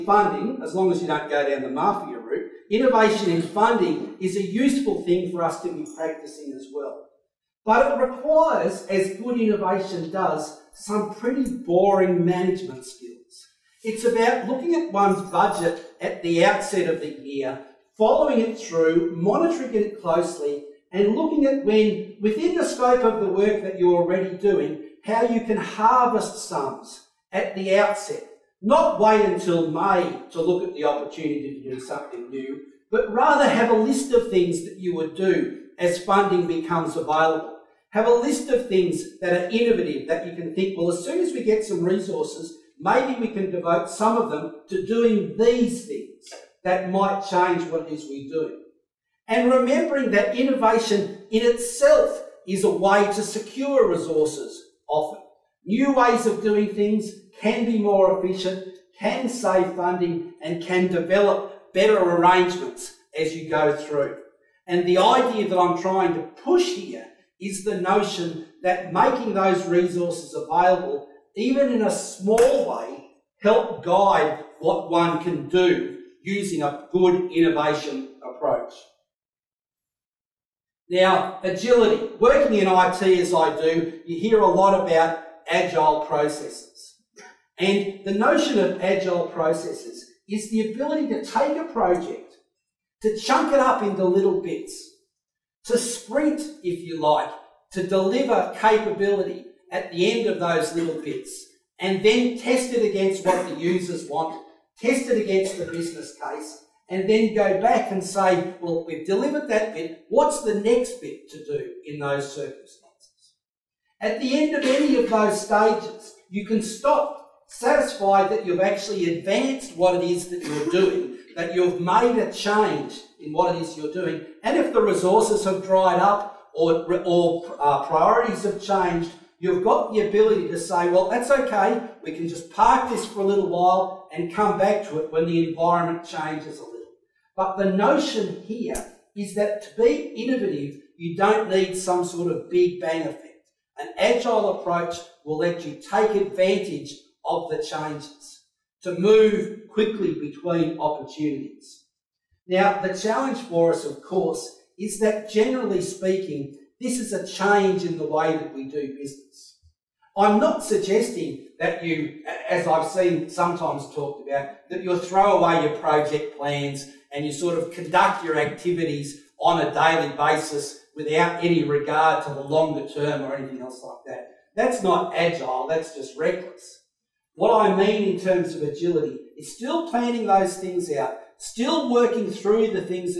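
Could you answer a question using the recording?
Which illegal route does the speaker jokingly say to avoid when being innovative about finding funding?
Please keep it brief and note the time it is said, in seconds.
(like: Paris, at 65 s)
mafia, at 1 s.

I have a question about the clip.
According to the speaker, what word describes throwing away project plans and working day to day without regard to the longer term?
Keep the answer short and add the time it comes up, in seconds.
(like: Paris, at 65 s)
reckless, at 176 s.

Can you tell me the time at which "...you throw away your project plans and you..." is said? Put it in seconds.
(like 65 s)
164 s.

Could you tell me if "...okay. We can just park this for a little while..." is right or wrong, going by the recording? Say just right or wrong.
right.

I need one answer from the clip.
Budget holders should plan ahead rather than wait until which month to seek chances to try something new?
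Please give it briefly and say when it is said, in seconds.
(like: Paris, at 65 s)
May, at 29 s.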